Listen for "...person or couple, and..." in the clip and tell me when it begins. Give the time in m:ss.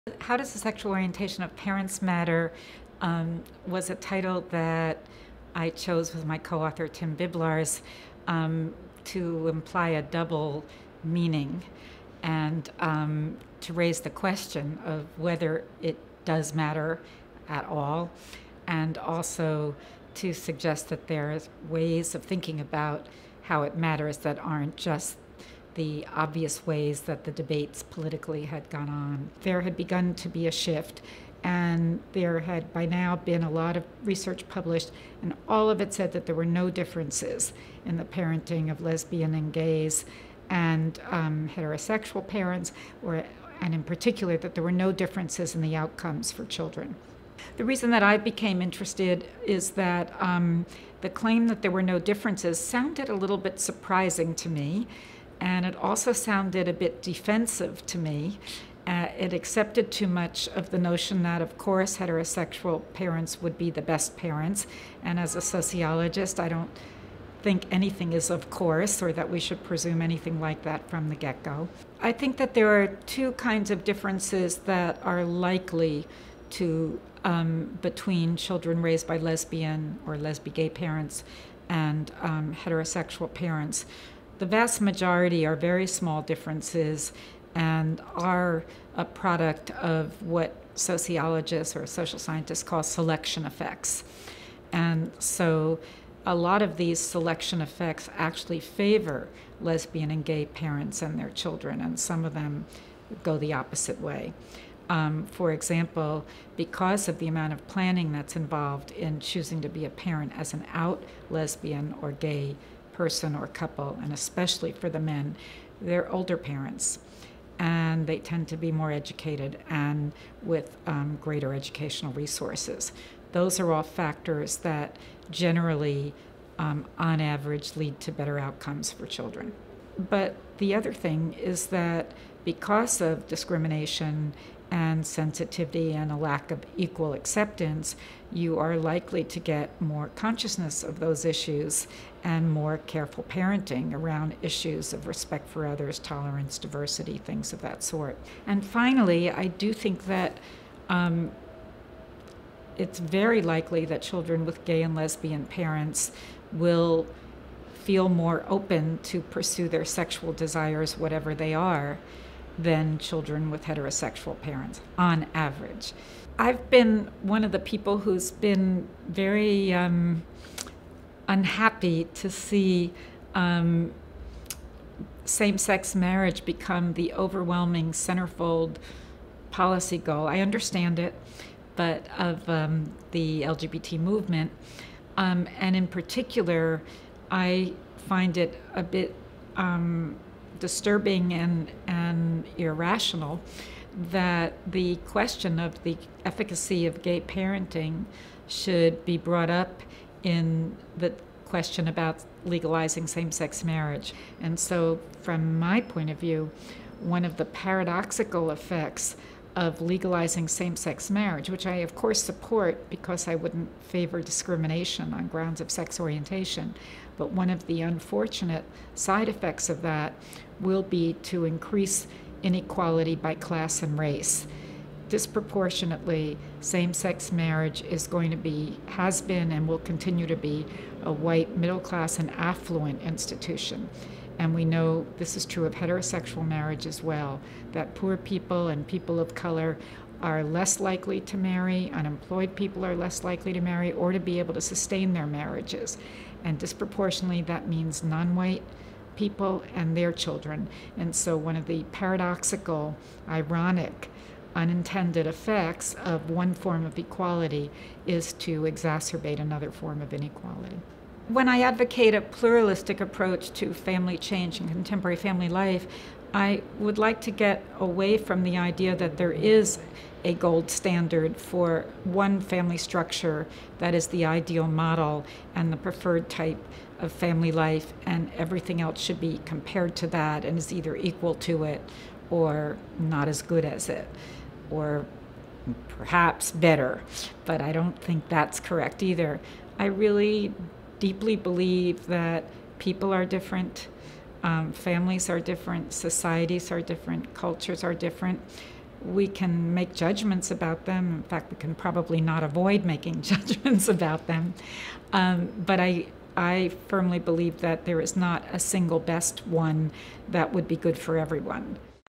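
1:53.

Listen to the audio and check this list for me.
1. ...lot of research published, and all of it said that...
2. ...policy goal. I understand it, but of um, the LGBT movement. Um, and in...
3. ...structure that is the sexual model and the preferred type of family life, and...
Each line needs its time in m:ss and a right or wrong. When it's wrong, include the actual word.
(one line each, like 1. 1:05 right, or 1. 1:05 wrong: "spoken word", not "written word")
1. 0:33 right
2. 2:59 right
3. 4:32 wrong: "ideal", not "sexual".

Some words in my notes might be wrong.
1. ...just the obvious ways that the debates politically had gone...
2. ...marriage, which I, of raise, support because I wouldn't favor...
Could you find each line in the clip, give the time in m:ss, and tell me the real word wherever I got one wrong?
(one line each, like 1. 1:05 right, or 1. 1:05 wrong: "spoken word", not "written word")
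1. 0:24 right
2. 3:31 wrong: "course", not "raise".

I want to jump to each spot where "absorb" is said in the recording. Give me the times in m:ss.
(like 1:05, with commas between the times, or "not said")
not said.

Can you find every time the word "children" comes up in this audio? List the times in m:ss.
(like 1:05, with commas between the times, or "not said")
0:46, 1:18, 1:41, 2:09, 2:34, 2:42, 4:10.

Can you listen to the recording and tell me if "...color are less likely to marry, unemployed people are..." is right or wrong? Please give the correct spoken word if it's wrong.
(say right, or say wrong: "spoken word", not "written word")
right.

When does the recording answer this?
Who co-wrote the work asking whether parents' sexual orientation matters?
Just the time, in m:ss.
0:06.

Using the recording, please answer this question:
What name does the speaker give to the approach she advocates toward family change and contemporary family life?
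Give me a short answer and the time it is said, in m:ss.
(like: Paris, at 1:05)
pluralistic approach, at 4:22.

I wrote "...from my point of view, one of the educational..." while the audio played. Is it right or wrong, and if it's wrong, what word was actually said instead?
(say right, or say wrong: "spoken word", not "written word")
wrong: "paradoxical", not "educational".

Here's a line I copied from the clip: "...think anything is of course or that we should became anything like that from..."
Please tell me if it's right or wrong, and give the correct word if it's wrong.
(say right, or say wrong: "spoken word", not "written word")
wrong: "presume", not "became".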